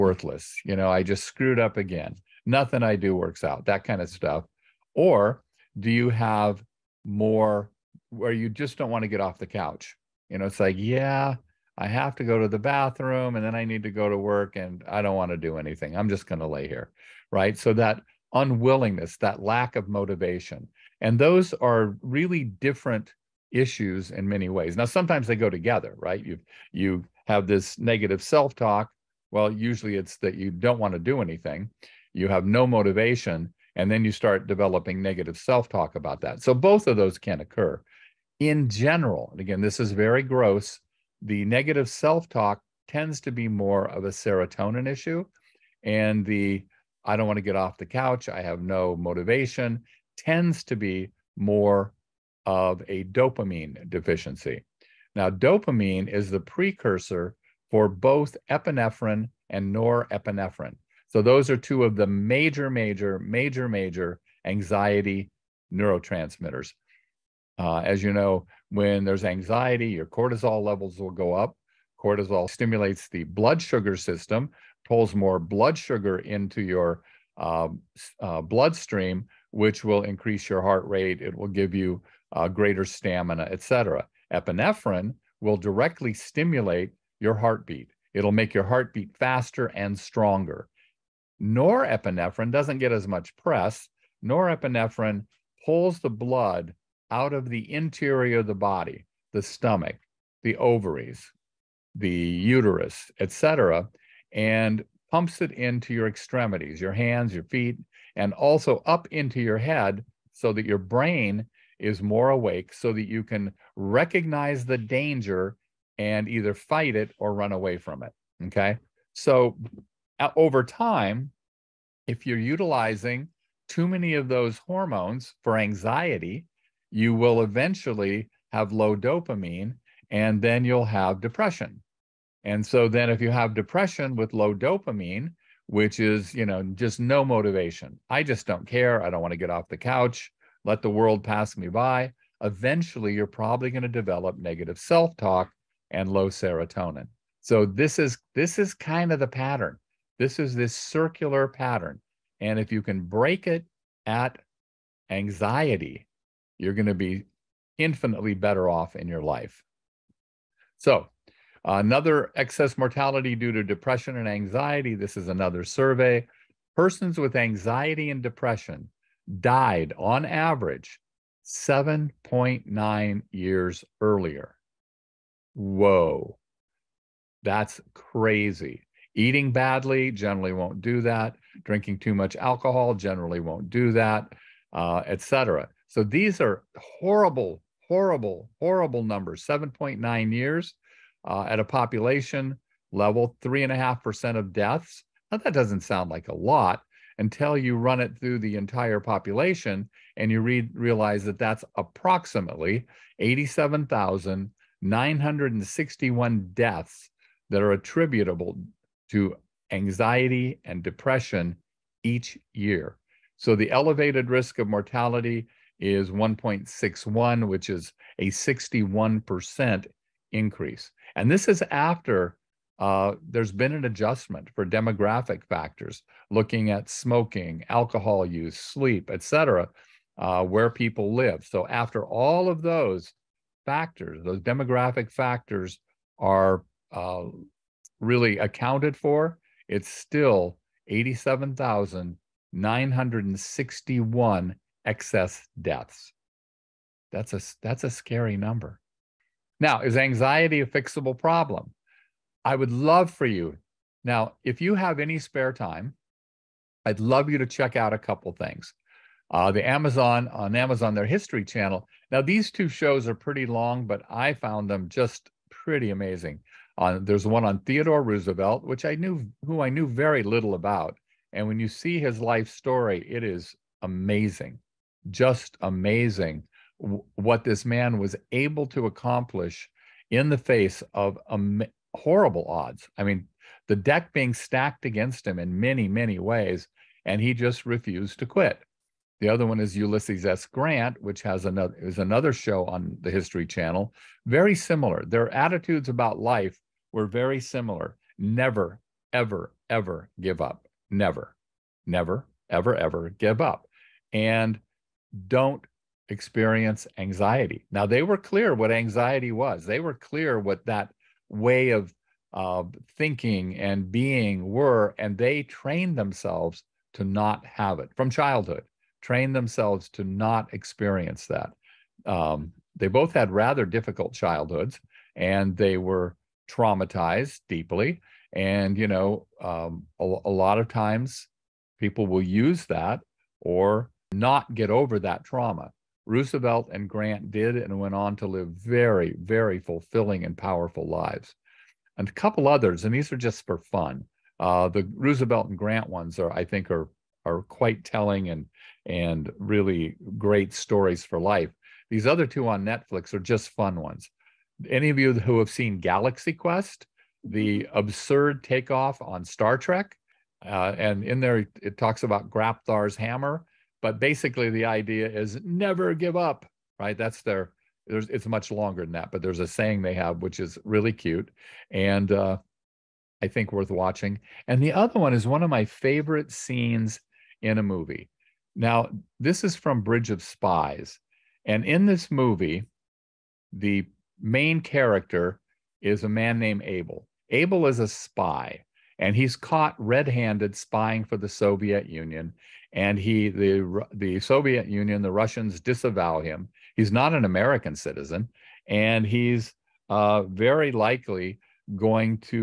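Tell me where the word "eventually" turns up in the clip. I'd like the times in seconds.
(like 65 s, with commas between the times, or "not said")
127 s, 142 s.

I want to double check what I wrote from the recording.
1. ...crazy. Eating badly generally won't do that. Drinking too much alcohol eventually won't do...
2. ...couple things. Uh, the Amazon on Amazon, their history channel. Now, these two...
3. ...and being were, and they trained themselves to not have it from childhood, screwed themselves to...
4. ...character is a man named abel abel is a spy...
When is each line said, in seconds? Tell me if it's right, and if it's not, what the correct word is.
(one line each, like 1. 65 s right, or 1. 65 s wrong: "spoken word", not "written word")
1. 177 s wrong: "generally", not "eventually"
2. 257 s right
3. 313 s wrong: "trained", not "screwed"
4. 384 s right.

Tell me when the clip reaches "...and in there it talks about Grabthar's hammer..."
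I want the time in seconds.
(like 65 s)
360 s.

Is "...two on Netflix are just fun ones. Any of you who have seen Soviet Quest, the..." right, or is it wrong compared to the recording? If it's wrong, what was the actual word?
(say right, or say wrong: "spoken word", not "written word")
wrong: "Galaxy", not "Soviet".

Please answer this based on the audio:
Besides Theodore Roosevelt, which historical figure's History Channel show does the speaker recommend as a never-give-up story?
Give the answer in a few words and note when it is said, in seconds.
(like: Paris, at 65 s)
Ulysses S. Grant, at 289 s.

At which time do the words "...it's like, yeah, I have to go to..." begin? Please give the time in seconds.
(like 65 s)
10 s.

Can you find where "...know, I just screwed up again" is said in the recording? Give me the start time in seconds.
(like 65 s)
0 s.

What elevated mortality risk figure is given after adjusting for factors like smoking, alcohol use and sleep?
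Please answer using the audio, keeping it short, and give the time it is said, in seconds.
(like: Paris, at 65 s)
1.61, at 216 s.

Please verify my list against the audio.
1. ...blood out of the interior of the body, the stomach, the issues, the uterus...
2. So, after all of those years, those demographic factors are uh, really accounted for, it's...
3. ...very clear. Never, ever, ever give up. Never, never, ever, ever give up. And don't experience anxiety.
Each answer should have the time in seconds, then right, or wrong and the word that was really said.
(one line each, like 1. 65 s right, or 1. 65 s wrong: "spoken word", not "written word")
1. 96 s wrong: "ovaries", not "issues"
2. 231 s wrong: "factors", not "years"
3. 297 s wrong: "similar", not "clear".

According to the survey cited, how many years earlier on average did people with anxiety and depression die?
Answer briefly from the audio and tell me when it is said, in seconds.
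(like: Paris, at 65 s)
7.9 years, at 171 s.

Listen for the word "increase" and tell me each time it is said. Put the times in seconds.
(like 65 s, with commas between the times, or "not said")
80 s, 220 s.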